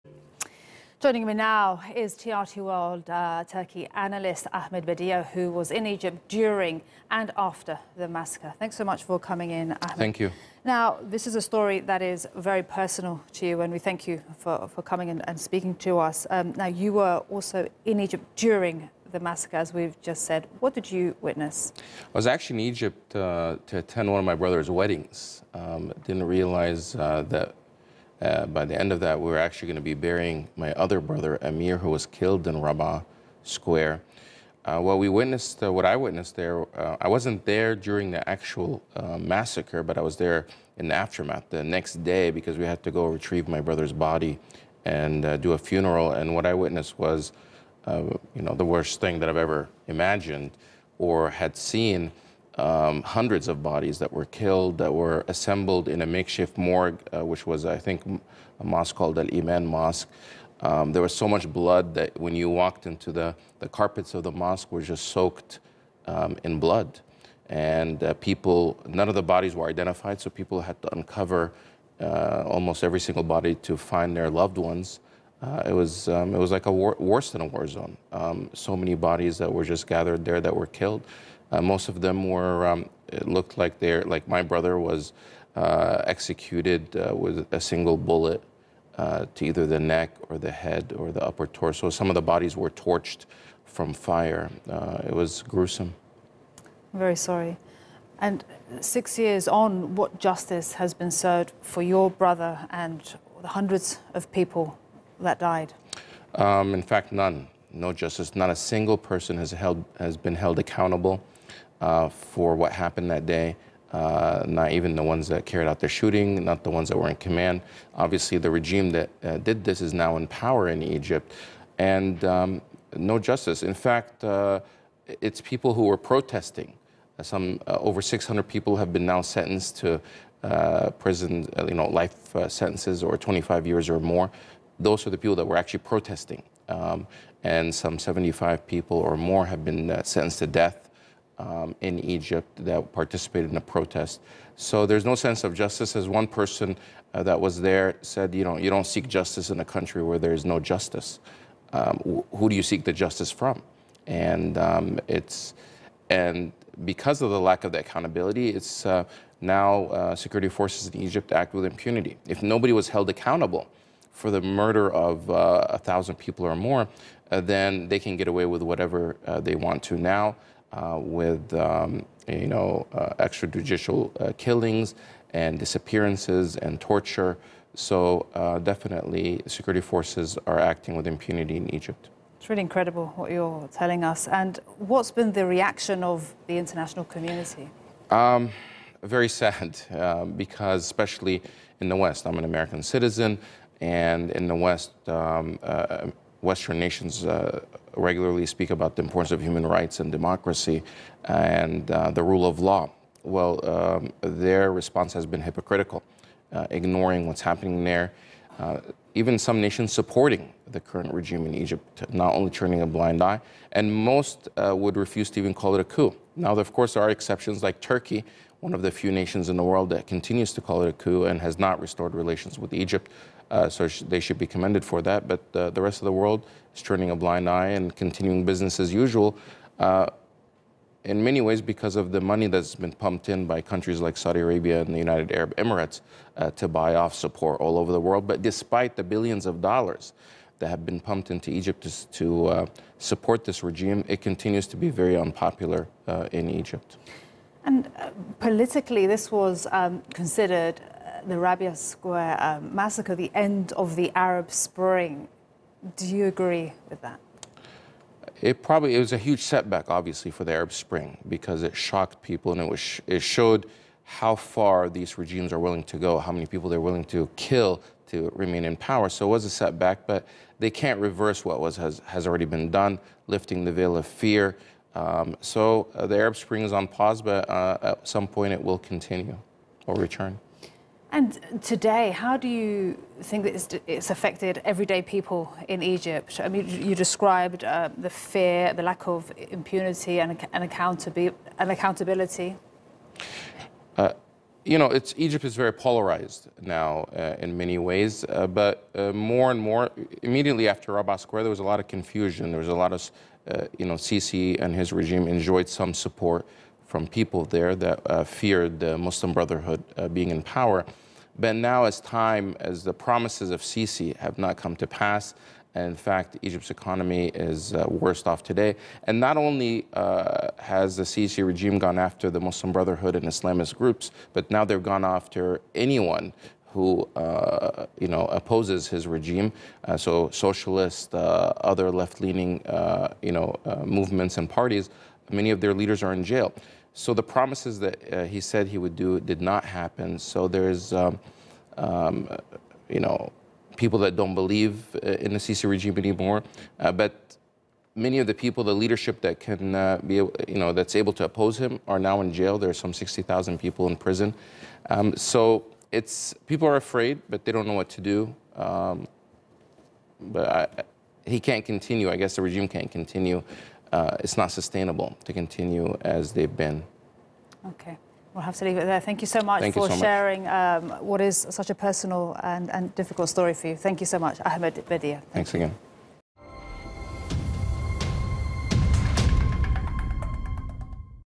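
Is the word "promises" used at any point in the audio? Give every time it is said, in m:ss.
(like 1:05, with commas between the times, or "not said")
5:12, 5:37.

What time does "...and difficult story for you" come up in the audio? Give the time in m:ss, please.
6:12.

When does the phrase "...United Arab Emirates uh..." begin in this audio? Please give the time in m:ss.
3:54.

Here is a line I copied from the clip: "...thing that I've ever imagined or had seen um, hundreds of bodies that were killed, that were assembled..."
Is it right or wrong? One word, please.
right.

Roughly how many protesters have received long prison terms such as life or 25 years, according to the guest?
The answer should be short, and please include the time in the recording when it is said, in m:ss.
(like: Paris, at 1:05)
Over 600, at 2:07.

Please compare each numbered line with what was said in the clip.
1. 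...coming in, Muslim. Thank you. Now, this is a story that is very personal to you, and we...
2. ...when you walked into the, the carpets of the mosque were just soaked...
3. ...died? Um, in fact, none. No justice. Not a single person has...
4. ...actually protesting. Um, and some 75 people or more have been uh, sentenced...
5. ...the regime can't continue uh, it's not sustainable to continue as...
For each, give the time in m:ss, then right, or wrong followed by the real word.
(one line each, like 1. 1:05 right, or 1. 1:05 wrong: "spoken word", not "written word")
1. 0:09 wrong: "Ahmed", not "Muslim"
2. 1:02 right
3. 1:45 right
4. 2:15 right
5. 6:02 right.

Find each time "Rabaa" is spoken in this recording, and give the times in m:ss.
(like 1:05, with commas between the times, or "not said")
0:32, 4:11, 5:00.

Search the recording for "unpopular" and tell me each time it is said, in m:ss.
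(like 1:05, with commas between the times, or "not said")
4:05.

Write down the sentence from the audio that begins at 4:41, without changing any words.
And today, how do you think that it's, it's affected everyday people in Egypt?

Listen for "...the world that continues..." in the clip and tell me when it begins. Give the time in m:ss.
3:39.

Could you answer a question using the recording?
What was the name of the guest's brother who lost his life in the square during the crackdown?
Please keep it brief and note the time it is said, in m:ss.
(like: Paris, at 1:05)
Amir, at 0:31.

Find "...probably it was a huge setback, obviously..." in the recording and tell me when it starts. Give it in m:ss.
4:18.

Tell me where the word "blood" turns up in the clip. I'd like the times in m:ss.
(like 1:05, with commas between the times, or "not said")
1:01, 1:06.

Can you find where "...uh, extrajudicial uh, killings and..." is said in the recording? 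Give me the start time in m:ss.
2:52.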